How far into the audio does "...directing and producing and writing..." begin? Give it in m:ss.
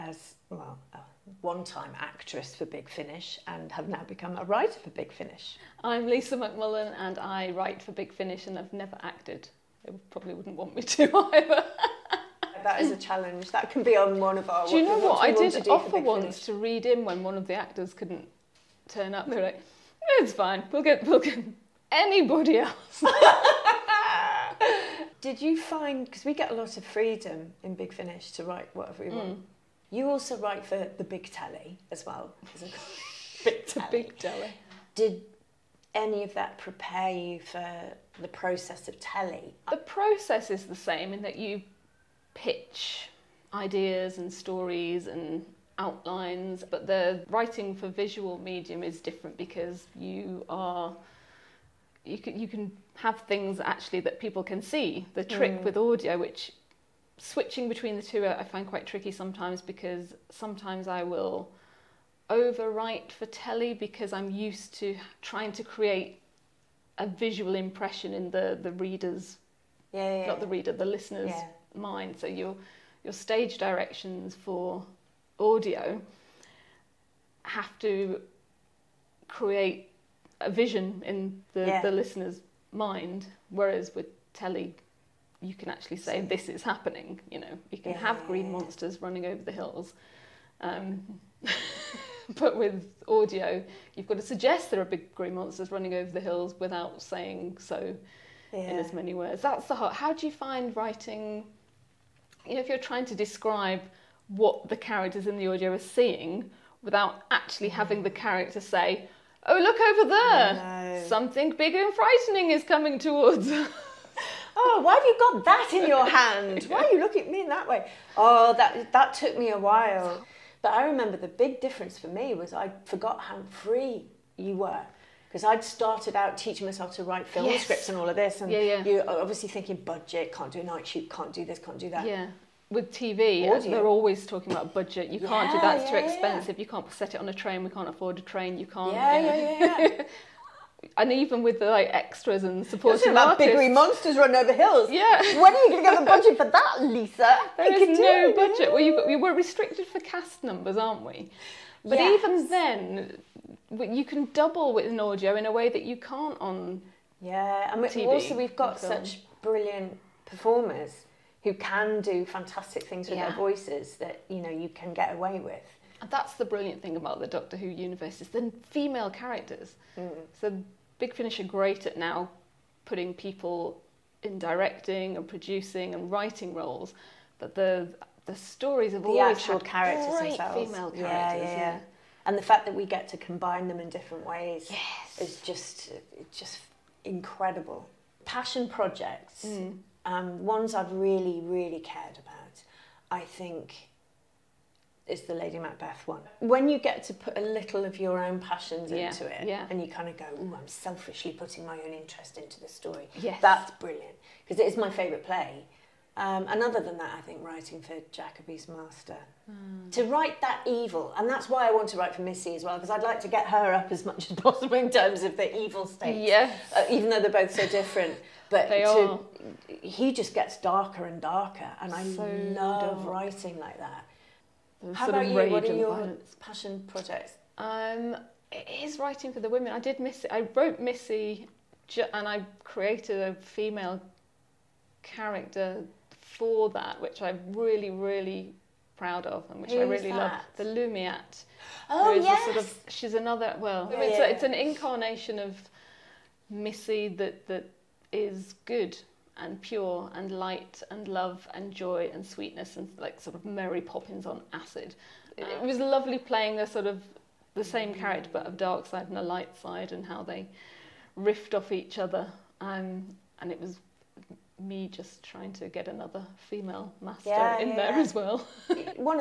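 2:54.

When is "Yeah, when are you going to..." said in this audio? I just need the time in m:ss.
2:24.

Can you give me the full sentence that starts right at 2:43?
their voices that you know you can get away with.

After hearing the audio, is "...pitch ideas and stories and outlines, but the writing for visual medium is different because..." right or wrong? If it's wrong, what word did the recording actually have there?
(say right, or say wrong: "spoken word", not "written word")
right.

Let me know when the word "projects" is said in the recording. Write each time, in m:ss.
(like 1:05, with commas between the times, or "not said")
3:08, 3:46.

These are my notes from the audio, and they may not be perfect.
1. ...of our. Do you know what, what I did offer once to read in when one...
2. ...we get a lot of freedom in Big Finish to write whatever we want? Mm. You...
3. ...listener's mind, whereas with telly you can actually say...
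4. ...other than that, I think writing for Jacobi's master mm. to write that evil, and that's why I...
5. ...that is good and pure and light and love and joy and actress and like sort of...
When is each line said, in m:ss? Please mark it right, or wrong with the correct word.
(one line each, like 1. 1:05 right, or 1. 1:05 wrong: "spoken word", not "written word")
1. 0:14 right
2. 0:26 right
3. 1:21 right
4. 3:26 right
5. 4:07 wrong: "sweetness", not "actress".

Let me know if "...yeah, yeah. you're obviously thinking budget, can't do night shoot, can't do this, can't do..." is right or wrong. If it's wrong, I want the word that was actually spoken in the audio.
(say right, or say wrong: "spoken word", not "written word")
right.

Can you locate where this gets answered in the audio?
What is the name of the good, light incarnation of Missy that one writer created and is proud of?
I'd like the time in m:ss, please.
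4:00.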